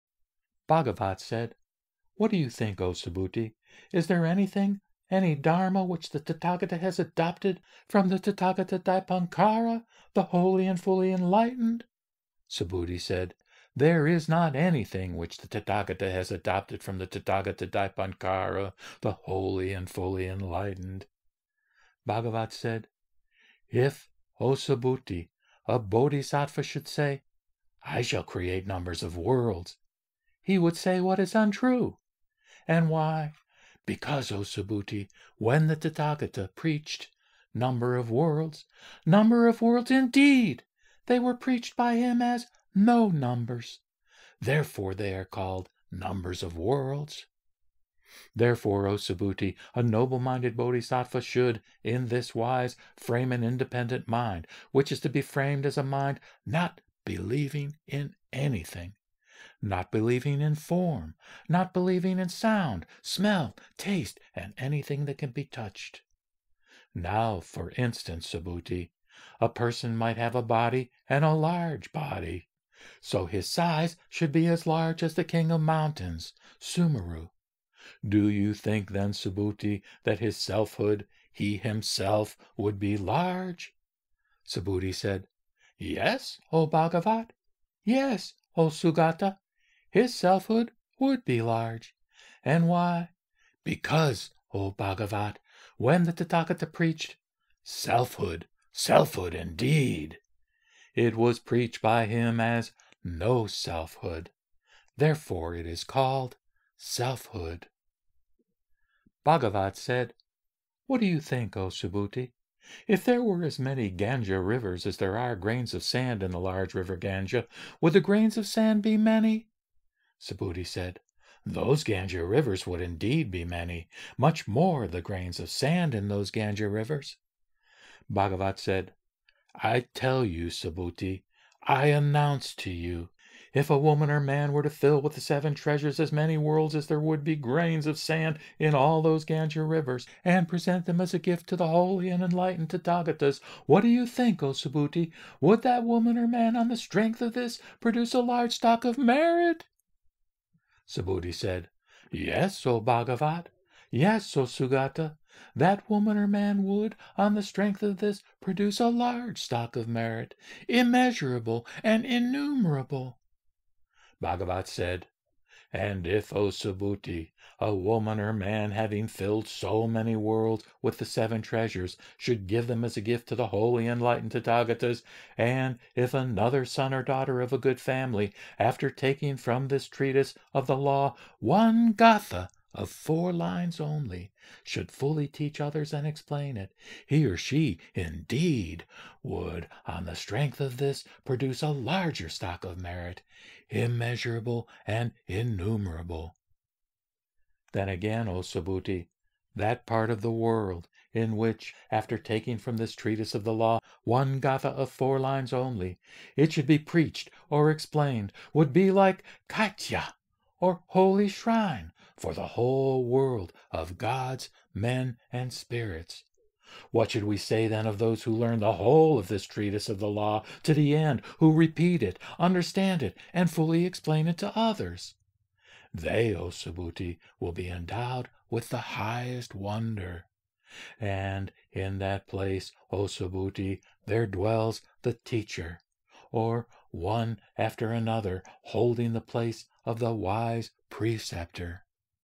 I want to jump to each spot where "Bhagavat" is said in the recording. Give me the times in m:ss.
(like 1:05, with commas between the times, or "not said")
0:00, 0:22, 1:26, 1:34, 1:49, 2:08, 2:32, 2:44.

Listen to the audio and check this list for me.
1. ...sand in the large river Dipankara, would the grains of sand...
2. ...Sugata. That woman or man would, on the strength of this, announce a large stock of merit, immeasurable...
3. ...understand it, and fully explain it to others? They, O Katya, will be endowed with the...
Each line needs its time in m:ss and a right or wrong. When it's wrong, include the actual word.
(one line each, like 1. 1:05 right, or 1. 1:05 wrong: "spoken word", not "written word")
1. 1:55 wrong: "Ganga", not "Dipankara"
2. 2:34 wrong: "produce", not "announce"
3. 3:42 wrong: "Subhuti", not "Katya".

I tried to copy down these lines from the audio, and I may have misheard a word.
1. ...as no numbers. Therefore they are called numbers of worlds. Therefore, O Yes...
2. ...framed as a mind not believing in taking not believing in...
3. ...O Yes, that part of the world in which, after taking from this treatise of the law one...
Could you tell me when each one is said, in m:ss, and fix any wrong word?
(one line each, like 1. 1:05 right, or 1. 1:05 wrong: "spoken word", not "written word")
1. 0:42 wrong: "Subhuti", not "Yes"
2. 0:55 wrong: "anything", not "taking"
3. 3:18 wrong: "Subhuti", not "Yes".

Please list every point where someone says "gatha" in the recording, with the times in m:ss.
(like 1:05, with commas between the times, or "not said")
3:01, 3:24.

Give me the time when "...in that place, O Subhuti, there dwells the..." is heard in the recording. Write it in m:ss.
3:51.